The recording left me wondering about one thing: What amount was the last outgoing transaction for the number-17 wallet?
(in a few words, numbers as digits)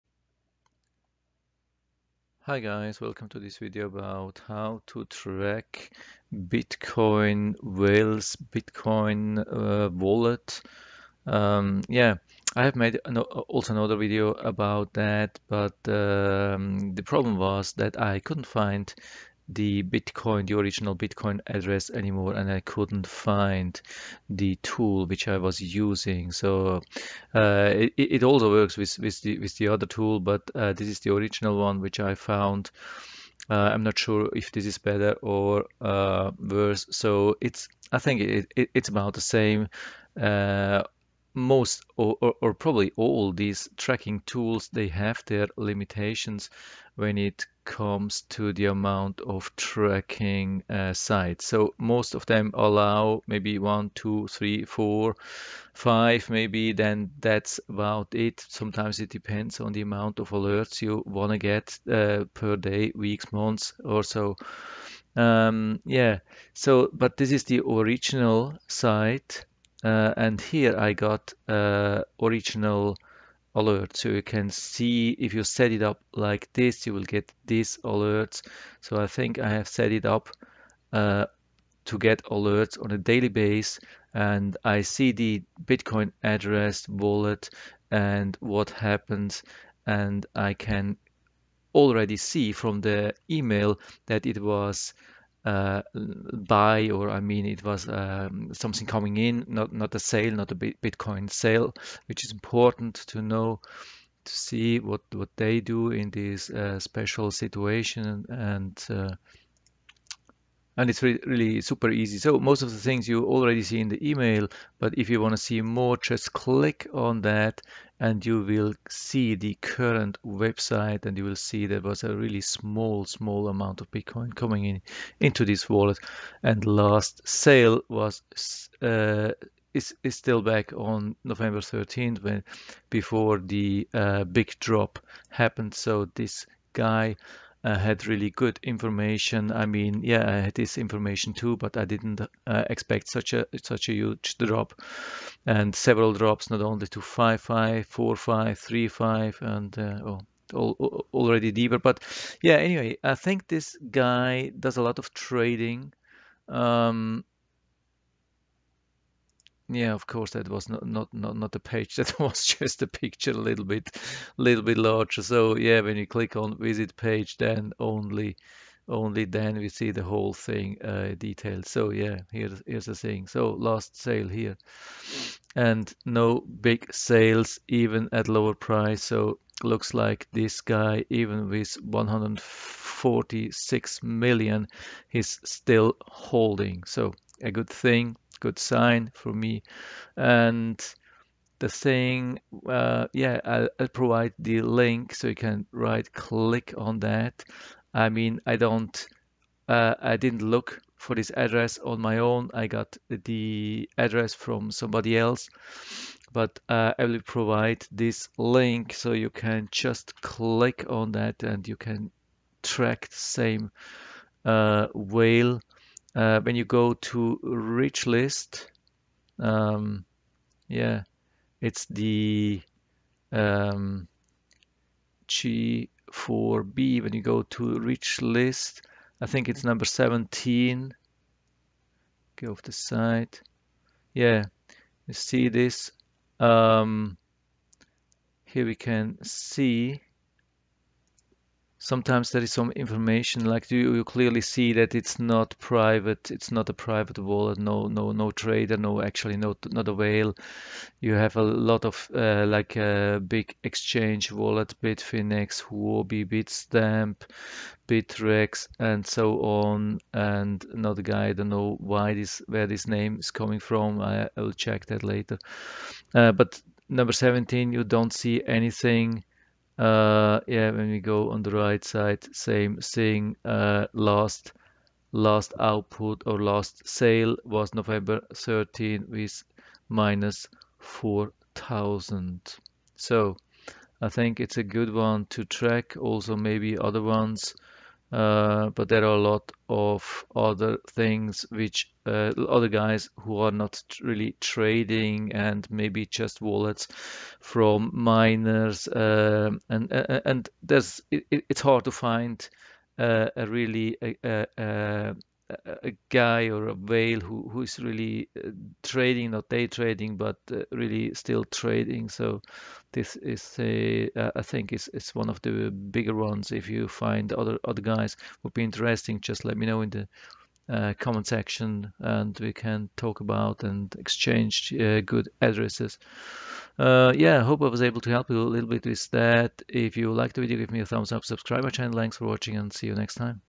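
-4000.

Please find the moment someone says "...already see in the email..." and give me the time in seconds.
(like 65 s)
113 s.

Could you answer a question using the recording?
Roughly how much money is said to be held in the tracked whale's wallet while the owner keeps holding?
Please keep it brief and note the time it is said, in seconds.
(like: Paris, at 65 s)
146 million, at 181 s.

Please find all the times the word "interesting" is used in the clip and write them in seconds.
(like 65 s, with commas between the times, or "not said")
318 s.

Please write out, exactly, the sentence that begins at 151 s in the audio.
But yeah, anyway, I think this guy does a lot of trading.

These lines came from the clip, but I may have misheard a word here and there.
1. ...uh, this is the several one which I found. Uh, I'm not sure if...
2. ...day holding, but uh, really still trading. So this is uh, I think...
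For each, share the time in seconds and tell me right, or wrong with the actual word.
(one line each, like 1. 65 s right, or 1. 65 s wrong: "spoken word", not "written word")
1. 30 s wrong: "original", not "several"
2. 309 s wrong: "trading", not "holding".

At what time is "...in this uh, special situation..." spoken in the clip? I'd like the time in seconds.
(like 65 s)
105 s.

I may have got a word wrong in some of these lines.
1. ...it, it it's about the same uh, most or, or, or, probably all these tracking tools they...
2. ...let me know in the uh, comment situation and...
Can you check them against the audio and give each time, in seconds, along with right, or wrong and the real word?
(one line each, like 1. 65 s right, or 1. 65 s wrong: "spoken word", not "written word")
1. 38 s right
2. 319 s wrong: "section", not "situation".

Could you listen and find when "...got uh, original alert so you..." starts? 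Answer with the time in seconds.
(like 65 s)
70 s.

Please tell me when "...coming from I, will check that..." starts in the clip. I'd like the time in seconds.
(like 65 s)
263 s.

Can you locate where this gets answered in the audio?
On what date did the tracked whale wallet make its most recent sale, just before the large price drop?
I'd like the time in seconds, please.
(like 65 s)
131 s.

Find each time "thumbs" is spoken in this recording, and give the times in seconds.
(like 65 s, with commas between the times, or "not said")
330 s.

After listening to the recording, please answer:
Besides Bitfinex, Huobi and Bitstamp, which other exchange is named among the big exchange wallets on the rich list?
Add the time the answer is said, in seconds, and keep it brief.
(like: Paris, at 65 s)
Bittrex, at 257 s.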